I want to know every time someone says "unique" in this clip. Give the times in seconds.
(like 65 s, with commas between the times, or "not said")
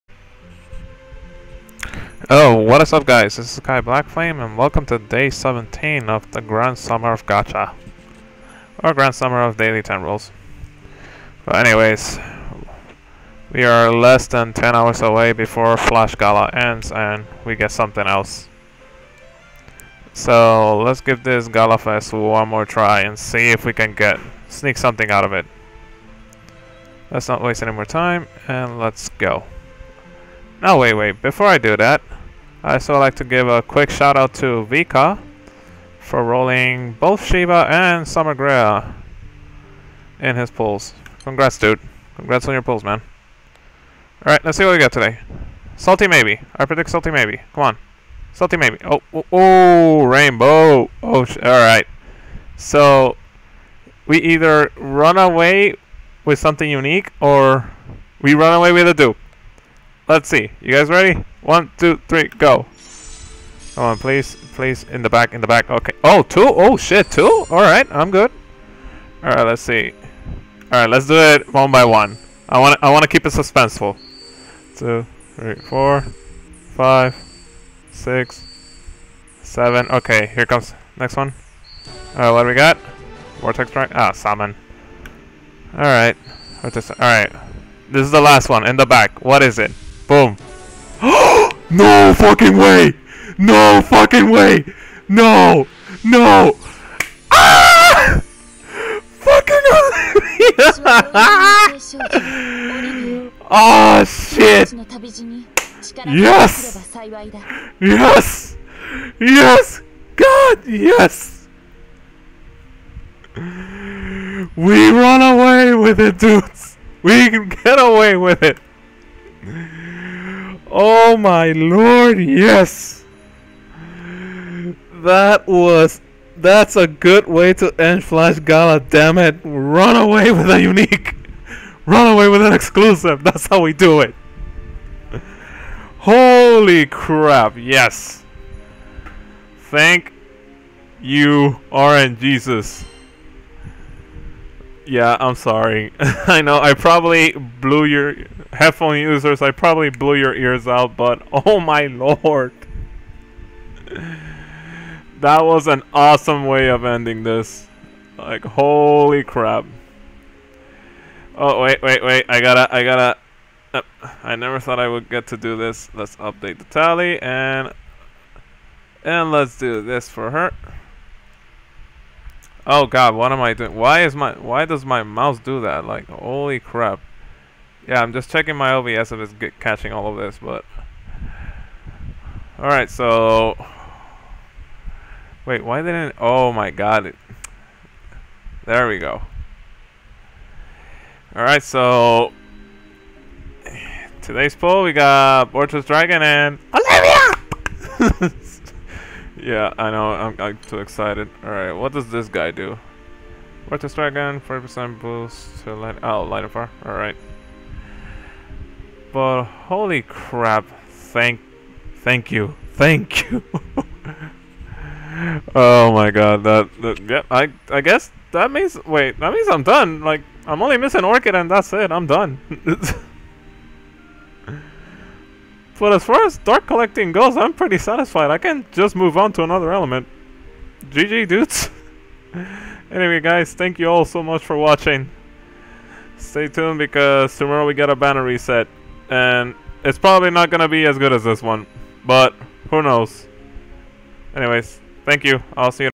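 56 s, 130 s.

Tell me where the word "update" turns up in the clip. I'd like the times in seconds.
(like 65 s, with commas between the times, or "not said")
166 s.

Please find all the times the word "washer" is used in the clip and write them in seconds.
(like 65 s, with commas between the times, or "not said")
not said.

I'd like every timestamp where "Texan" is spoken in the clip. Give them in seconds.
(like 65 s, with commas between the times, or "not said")
not said.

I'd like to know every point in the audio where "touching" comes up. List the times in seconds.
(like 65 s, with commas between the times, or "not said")
not said.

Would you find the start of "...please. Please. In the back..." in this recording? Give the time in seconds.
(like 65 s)
63 s.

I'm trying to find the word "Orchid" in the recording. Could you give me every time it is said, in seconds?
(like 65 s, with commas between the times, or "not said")
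221 s.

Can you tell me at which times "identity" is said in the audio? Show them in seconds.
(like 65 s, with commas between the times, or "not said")
not said.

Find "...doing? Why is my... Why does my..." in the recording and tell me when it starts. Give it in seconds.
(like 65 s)
173 s.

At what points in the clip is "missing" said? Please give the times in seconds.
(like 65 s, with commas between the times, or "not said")
220 s.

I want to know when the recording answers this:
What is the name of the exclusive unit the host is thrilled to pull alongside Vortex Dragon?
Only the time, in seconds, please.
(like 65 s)
196 s.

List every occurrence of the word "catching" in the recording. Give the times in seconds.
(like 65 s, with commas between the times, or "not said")
179 s.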